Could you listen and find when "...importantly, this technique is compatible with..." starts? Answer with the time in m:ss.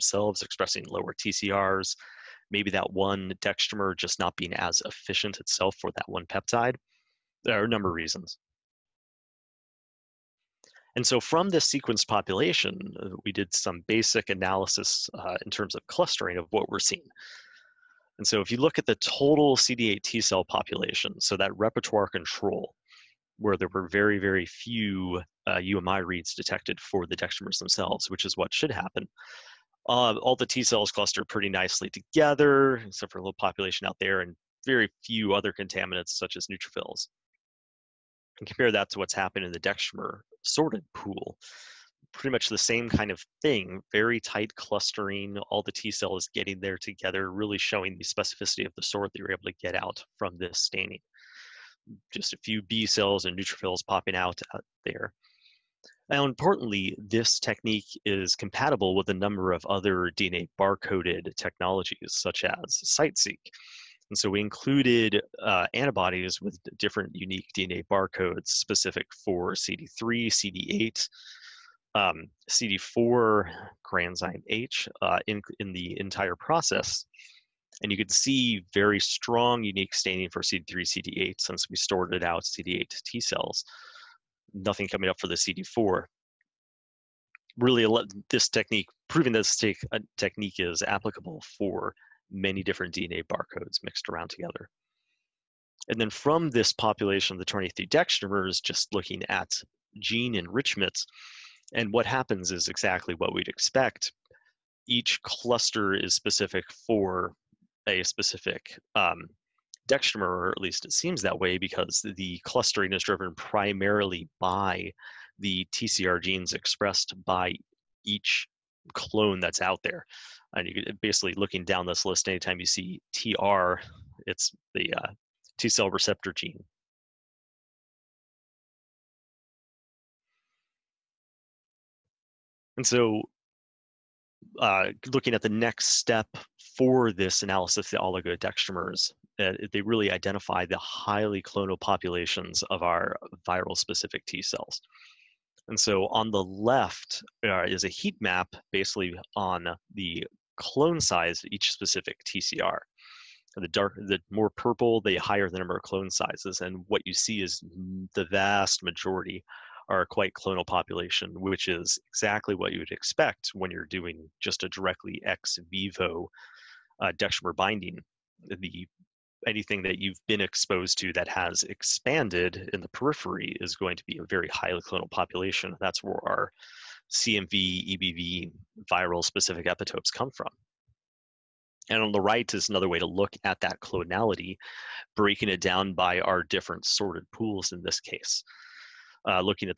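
0:56.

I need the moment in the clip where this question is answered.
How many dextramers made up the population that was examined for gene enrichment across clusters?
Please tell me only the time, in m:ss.
1:37.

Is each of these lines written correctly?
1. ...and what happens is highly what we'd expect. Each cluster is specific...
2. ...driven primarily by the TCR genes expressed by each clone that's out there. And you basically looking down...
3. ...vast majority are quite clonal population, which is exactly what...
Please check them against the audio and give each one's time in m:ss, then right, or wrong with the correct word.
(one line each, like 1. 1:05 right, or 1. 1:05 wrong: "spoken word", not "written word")
1. 1:41 wrong: "exactly", not "highly"
2. 1:53 right
3. 2:38 right.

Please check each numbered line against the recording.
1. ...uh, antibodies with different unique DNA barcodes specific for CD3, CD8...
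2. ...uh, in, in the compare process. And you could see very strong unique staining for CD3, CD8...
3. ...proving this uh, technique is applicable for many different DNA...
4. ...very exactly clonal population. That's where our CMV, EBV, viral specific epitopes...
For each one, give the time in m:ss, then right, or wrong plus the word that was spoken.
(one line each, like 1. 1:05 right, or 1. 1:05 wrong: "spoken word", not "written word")
1. 1:05 right
2. 1:14 wrong: "entire", not "compare"
3. 1:29 right
4. 2:54 wrong: "highly", not "exactly".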